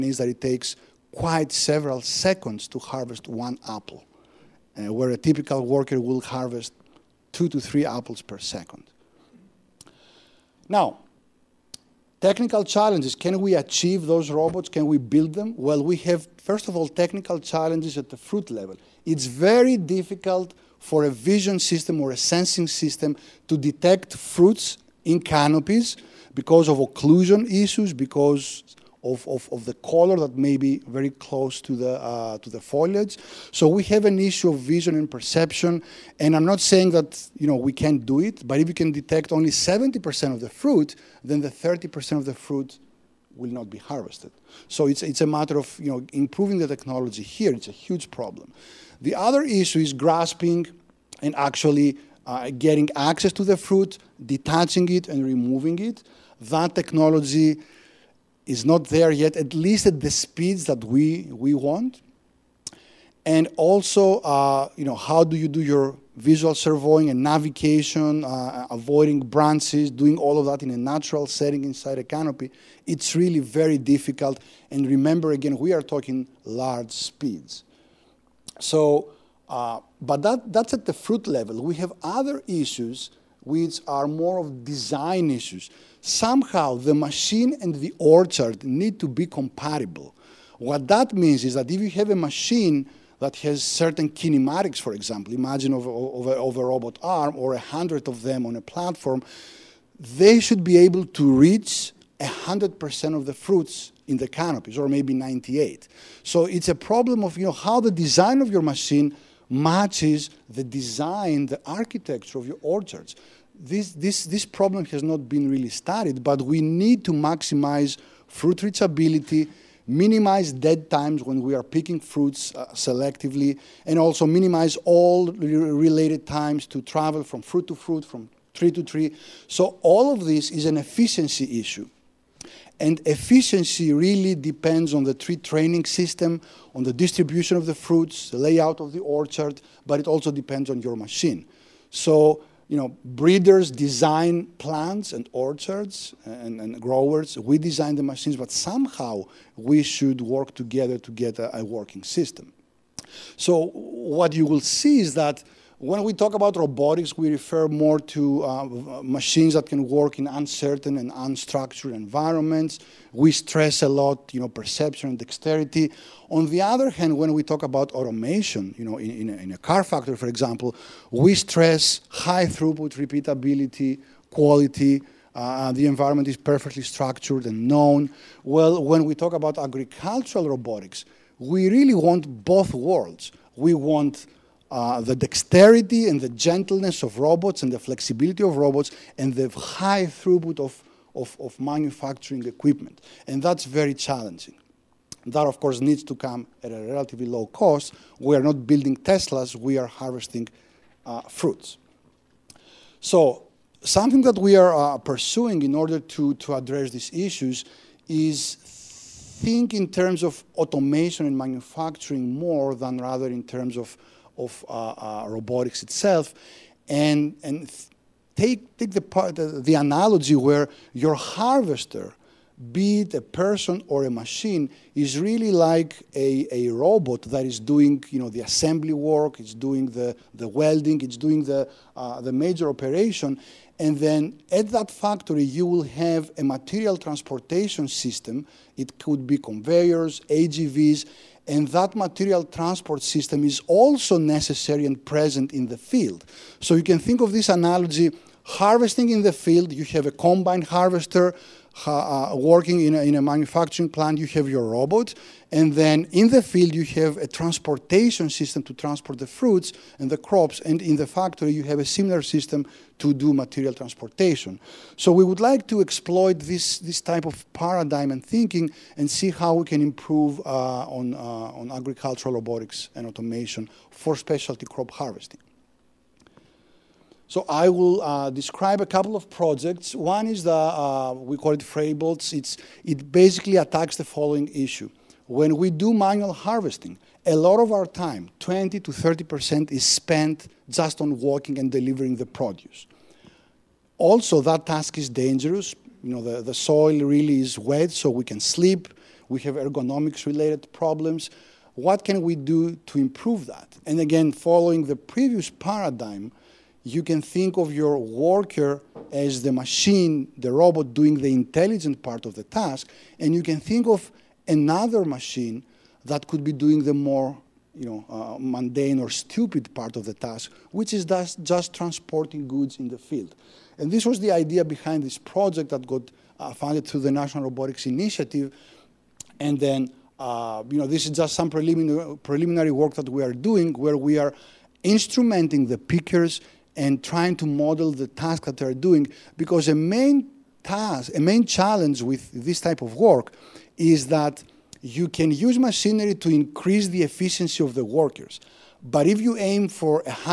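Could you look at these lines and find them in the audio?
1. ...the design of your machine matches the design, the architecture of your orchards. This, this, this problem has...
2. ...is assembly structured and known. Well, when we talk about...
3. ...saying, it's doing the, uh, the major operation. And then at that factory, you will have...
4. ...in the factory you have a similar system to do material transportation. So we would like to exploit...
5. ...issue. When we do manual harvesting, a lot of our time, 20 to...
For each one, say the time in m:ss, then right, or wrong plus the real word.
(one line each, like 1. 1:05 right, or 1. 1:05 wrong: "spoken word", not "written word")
1. 1:47 right
2. 2:56 wrong: "perfectly", not "assembly"
3. 3:50 wrong: "welding", not "saying"
4. 4:20 right
5. 4:44 right.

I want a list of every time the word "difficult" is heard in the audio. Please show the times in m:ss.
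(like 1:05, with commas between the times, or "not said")
0:19, 1:13.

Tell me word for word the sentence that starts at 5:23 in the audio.
And this was the idea behind this project that got uh, funded through the National Robotics Initiative.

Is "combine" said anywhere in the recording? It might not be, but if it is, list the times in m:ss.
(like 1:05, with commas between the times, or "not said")
4:10.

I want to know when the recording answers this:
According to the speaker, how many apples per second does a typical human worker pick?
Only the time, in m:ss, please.
0:07.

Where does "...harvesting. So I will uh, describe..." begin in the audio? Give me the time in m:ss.
4:34.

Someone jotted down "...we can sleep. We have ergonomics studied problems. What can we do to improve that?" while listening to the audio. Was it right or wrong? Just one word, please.
wrong.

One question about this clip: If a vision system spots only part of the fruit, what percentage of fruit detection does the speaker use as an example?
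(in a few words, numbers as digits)
70%.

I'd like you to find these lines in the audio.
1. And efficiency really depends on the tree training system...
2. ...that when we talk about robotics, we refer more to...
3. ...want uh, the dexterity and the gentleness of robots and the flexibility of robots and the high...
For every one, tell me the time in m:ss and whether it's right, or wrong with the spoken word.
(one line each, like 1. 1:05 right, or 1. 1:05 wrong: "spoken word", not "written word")
1. 2:12 right
2. 2:35 right
3. 3:03 right.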